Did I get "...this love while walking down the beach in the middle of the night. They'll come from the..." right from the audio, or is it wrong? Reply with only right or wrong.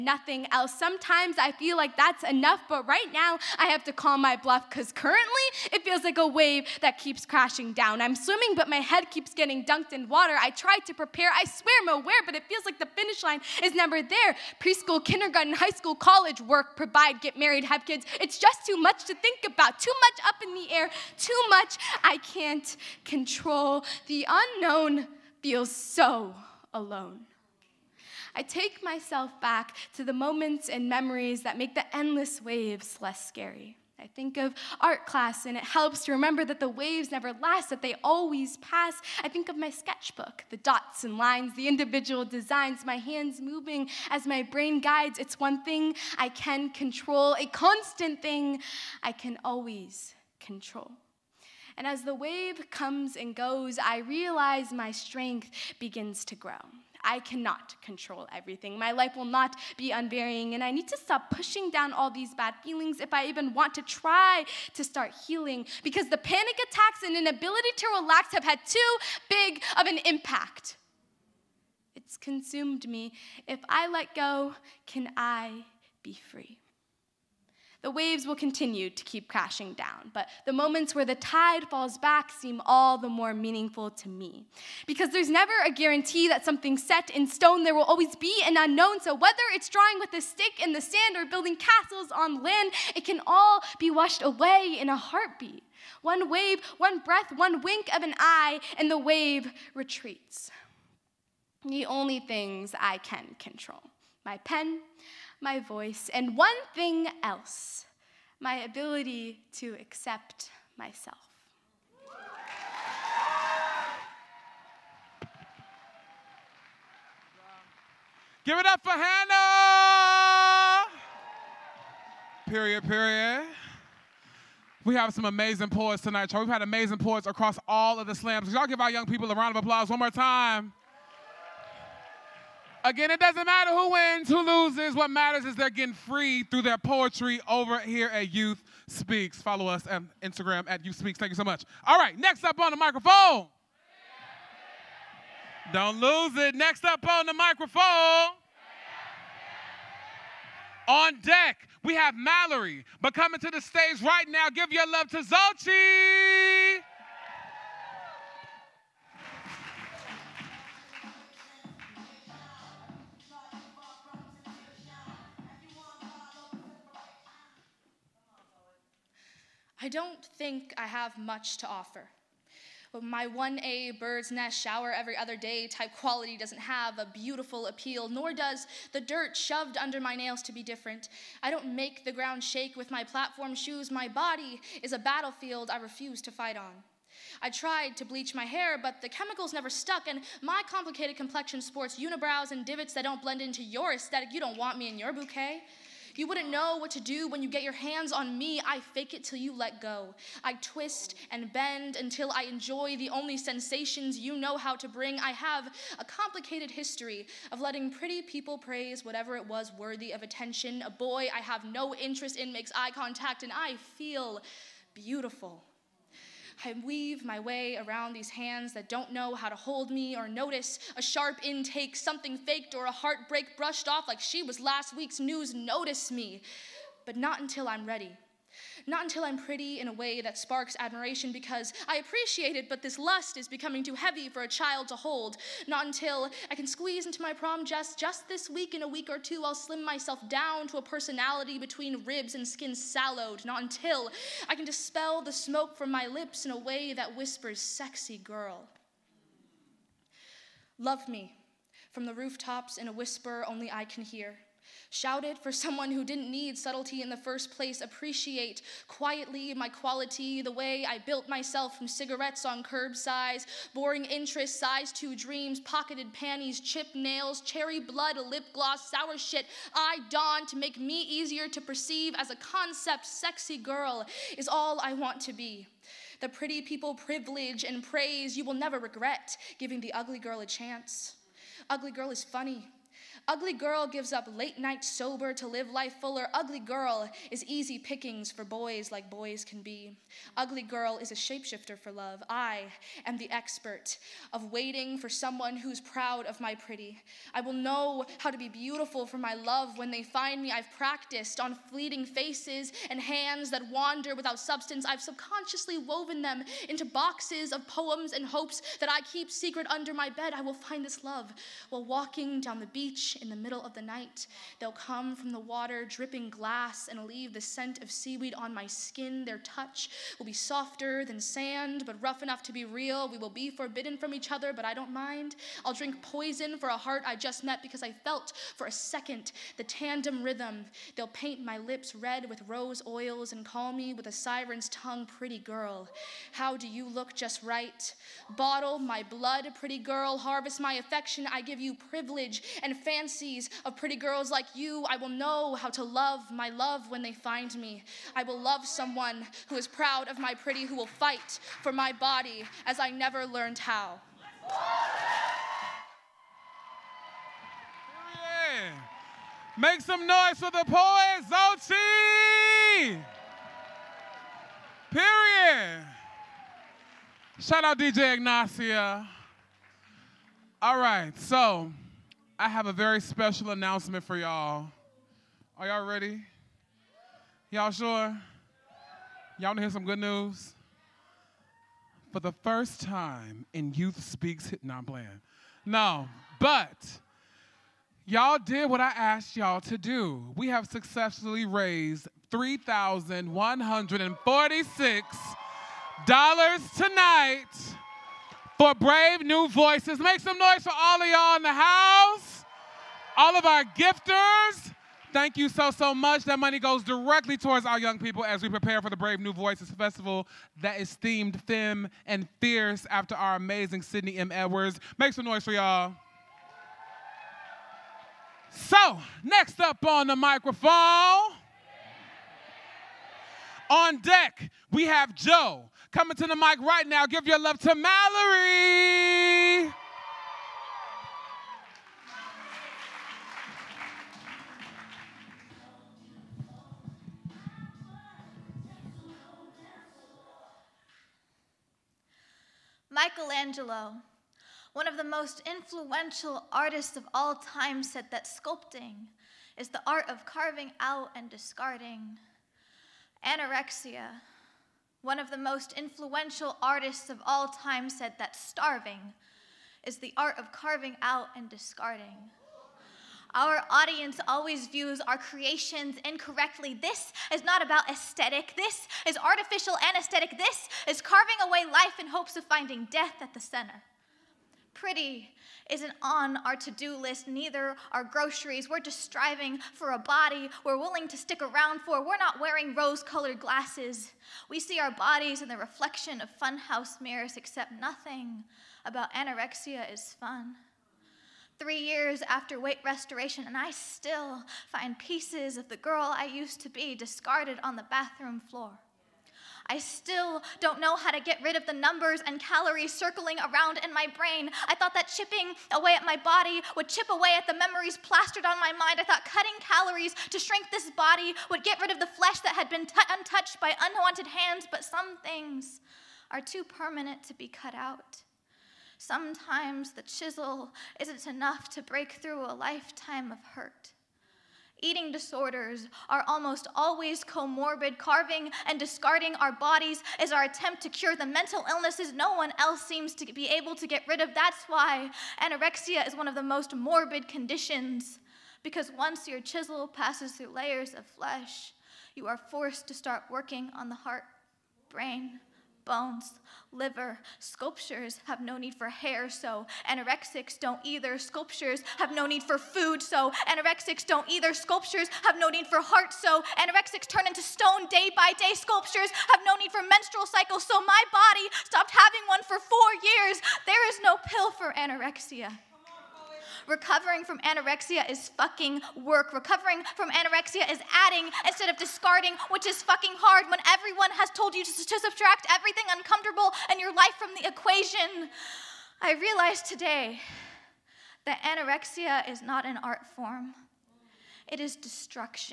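right.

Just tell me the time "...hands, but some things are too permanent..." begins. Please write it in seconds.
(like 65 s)
514 s.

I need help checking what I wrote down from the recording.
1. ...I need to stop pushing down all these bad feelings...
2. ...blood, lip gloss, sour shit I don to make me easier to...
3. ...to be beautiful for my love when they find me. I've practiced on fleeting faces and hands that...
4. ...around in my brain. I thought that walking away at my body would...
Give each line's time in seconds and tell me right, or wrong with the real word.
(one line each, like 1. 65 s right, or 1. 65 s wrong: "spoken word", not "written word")
1. 60 s right
2. 267 s right
3. 298 s right
4. 503 s wrong: "chipping", not "walking".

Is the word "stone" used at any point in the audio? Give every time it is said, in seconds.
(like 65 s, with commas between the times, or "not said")
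87 s, 557 s.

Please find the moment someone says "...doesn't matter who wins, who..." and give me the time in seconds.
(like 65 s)
133 s.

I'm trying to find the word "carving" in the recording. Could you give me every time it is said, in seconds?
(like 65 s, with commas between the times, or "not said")
450 s, 460 s, 471 s, 527 s.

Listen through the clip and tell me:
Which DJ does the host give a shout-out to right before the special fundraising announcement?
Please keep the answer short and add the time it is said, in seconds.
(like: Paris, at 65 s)
DJ Ignacia, at 367 s.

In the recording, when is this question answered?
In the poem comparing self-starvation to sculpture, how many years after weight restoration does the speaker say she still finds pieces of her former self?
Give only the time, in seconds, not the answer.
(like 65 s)
491 s.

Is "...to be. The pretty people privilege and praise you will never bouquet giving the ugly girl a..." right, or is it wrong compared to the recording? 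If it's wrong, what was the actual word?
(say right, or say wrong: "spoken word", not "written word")
wrong: "regret", not "bouquet".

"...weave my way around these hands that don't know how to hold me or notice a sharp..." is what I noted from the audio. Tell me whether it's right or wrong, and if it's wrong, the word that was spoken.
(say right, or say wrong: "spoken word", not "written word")
right.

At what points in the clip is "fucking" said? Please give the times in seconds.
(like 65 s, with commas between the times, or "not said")
568 s, 572 s.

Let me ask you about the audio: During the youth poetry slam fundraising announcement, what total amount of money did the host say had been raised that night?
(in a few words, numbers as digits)
$3,146.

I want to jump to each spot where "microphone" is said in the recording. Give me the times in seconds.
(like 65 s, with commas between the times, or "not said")
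142 s, 147 s, 420 s.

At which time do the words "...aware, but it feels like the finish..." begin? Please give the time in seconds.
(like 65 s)
12 s.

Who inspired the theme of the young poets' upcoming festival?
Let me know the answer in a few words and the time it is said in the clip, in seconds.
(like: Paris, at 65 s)
Sydney M. Edwards, at 413 s.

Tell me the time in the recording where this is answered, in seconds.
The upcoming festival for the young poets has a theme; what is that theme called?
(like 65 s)
411 s.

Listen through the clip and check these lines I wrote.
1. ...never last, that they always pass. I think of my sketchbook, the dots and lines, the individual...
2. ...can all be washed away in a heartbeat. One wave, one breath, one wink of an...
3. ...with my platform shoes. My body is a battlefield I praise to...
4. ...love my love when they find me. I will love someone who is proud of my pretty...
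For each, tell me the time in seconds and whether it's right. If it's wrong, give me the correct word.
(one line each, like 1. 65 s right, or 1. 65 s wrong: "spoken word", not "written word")
1. 37 s right
2. 93 s right
3. 182 s wrong: "refuse", not "praise"
4. 345 s right.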